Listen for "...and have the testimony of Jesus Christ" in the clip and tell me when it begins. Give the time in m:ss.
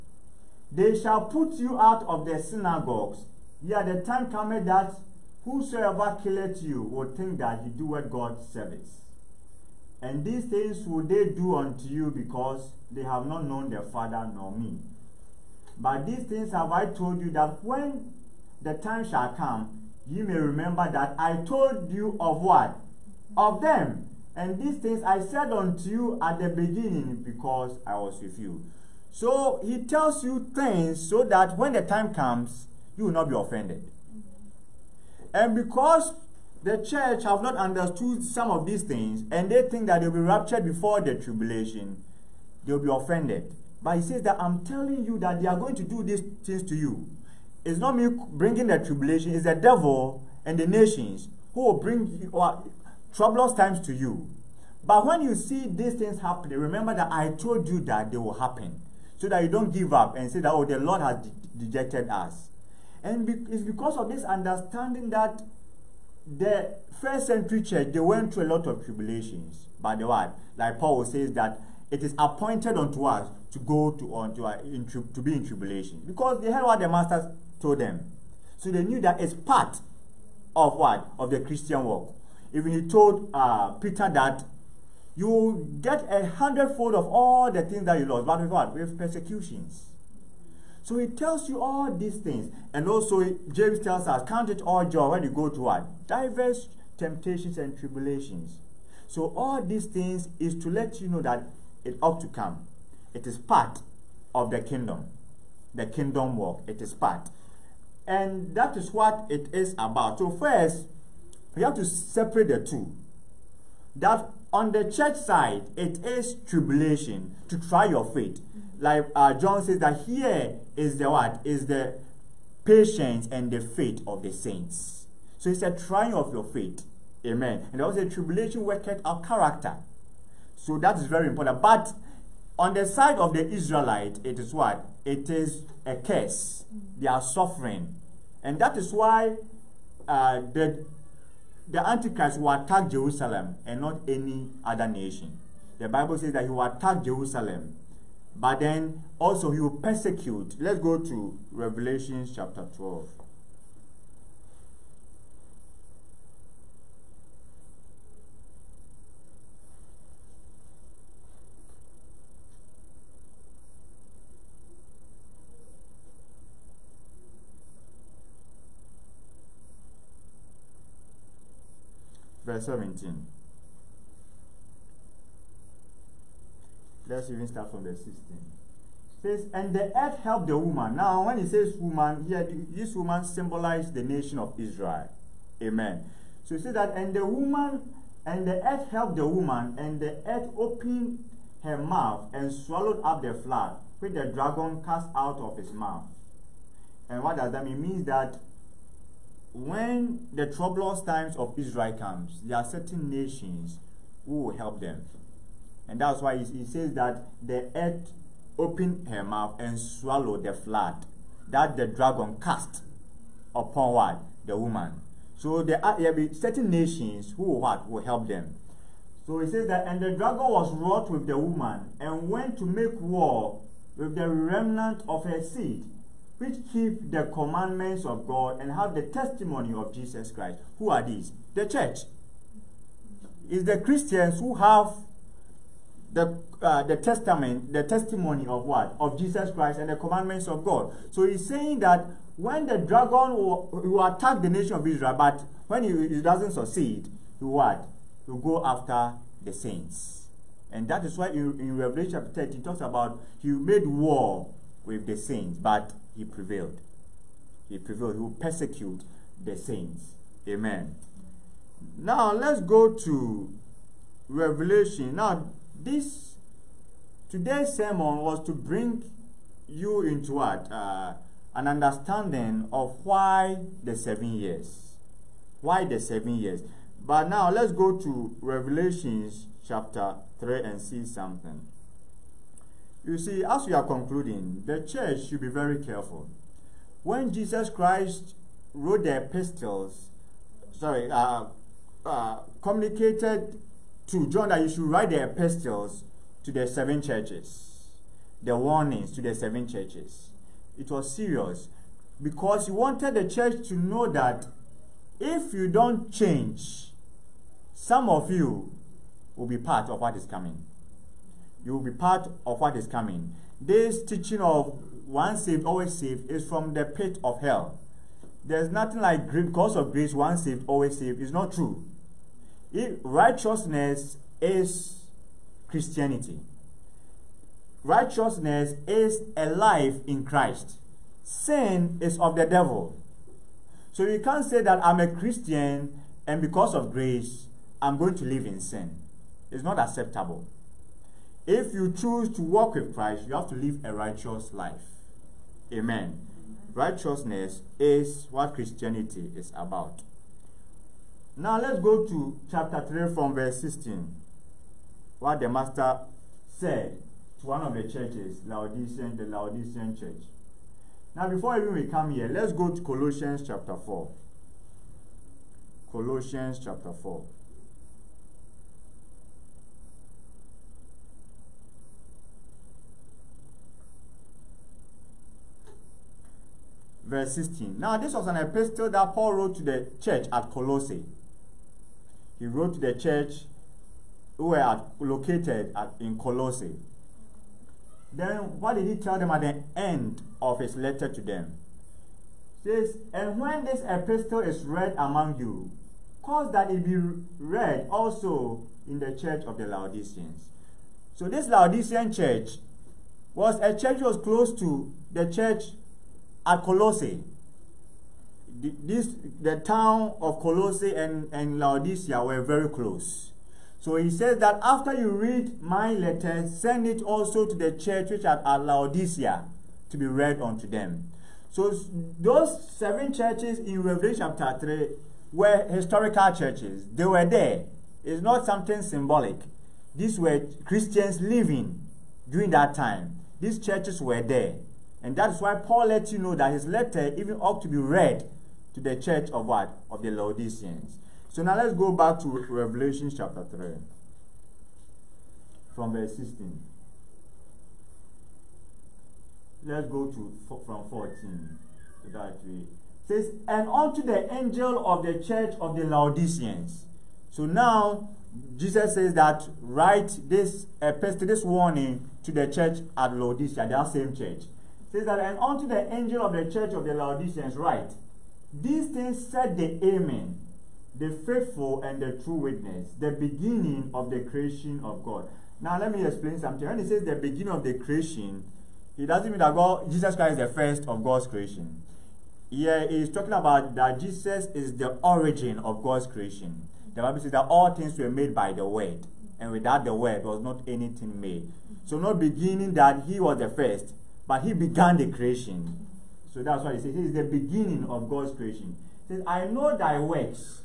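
3:48.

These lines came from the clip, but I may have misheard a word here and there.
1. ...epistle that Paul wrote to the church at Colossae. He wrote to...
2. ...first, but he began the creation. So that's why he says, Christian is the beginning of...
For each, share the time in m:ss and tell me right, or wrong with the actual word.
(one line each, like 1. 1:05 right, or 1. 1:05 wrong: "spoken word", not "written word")
1. 6:18 right
2. 8:13 wrong: "This", not "Christian".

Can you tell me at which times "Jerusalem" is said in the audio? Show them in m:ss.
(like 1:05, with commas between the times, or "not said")
2:22, 2:27.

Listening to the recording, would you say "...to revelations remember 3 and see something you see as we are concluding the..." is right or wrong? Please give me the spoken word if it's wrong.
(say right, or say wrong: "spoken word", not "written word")
wrong: "chapter", not "remember".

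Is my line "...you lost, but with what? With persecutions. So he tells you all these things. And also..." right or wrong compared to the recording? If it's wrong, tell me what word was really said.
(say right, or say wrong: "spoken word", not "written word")
right.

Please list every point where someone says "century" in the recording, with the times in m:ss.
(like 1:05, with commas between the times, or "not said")
1:07.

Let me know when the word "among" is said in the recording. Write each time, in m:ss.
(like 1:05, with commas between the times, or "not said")
6:34.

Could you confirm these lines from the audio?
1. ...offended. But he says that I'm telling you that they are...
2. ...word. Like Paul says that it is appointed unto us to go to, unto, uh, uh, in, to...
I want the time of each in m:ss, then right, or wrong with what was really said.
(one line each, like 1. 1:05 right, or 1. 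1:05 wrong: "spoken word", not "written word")
1. 0:42 right
2. 1:10 right.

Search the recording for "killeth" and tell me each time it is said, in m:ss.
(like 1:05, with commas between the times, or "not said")
0:06.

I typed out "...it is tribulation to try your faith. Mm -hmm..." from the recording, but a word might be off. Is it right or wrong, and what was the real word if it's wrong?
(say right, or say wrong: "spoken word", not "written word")
right.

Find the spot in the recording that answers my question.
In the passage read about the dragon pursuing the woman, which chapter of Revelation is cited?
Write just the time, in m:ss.
2:32.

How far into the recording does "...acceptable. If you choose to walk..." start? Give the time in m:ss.
5:39.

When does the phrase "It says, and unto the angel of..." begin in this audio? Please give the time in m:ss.
7:32.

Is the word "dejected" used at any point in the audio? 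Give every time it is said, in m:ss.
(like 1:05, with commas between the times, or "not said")
1:01.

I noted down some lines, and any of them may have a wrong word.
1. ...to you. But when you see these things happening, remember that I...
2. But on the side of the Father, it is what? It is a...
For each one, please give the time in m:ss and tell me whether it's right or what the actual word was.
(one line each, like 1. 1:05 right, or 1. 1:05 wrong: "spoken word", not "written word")
1. 0:53 right
2. 2:11 wrong: "Israelite", not "Father".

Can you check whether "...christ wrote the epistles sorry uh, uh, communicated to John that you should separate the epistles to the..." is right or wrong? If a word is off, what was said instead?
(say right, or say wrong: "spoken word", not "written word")
wrong: "write", not "separate".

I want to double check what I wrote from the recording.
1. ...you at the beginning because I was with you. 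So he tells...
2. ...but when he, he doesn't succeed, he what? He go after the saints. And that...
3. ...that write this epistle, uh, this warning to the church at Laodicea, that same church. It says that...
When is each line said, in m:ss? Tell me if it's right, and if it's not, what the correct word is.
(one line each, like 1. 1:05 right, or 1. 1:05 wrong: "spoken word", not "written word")
1. 0:25 right
2. 4:05 right
3. 7:39 right.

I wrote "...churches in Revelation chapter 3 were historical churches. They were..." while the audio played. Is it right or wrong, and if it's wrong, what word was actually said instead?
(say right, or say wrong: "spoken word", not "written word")
right.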